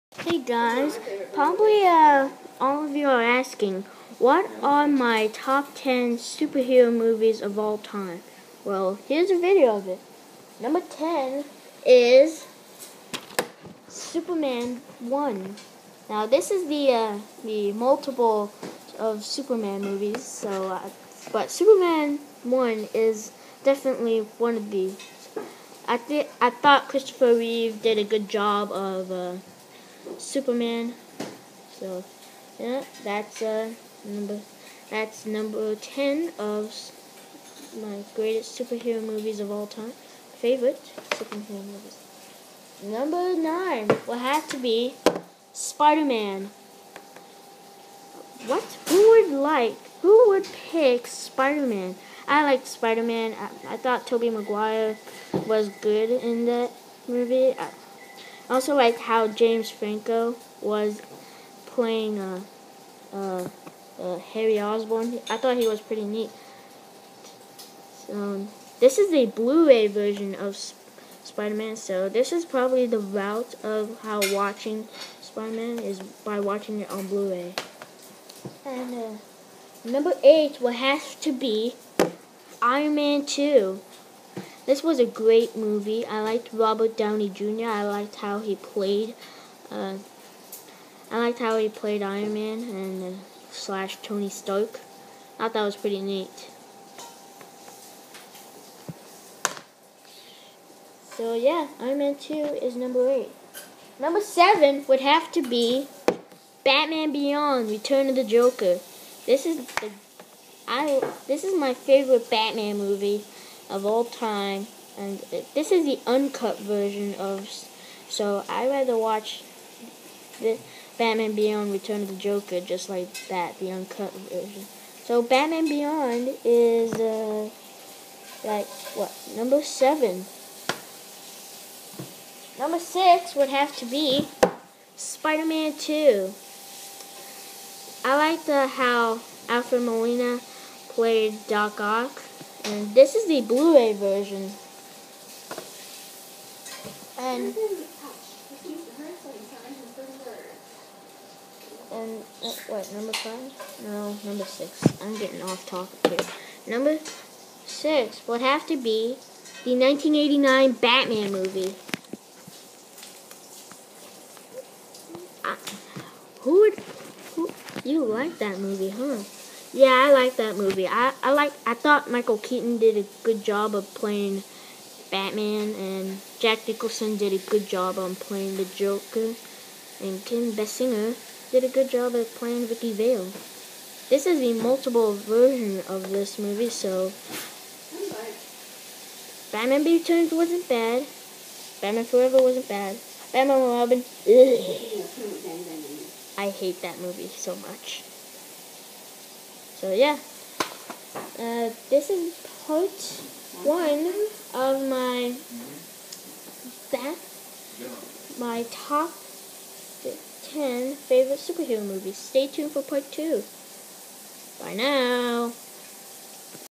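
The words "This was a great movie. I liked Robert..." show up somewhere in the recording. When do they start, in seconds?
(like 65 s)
84 s.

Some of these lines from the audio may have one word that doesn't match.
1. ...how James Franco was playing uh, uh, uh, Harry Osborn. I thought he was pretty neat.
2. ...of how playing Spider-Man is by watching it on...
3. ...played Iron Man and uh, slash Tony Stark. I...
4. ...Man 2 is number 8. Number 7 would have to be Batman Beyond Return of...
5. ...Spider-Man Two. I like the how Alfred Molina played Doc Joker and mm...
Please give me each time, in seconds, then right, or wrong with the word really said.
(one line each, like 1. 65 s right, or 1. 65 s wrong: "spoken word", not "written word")
1. 58 s right
2. 73 s wrong: "watching", not "playing"
3. 91 s right
4. 101 s right
5. 134 s wrong: "Ock", not "Joker".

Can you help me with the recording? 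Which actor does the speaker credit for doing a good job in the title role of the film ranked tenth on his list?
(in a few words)
Christopher Reeve.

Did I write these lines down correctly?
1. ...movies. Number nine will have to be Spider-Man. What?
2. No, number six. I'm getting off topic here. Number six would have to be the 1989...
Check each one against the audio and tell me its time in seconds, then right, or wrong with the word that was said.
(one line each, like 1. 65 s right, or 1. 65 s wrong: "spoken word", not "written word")
1. 41 s right
2. 153 s right.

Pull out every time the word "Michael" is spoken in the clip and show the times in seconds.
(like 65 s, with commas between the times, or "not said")
172 s.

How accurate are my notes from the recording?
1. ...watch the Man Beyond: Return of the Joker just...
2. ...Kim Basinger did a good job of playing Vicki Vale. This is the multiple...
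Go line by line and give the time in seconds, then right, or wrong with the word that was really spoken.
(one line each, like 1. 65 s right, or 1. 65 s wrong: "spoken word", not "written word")
1. 118 s wrong: "Batman", not "Man"
2. 180 s right.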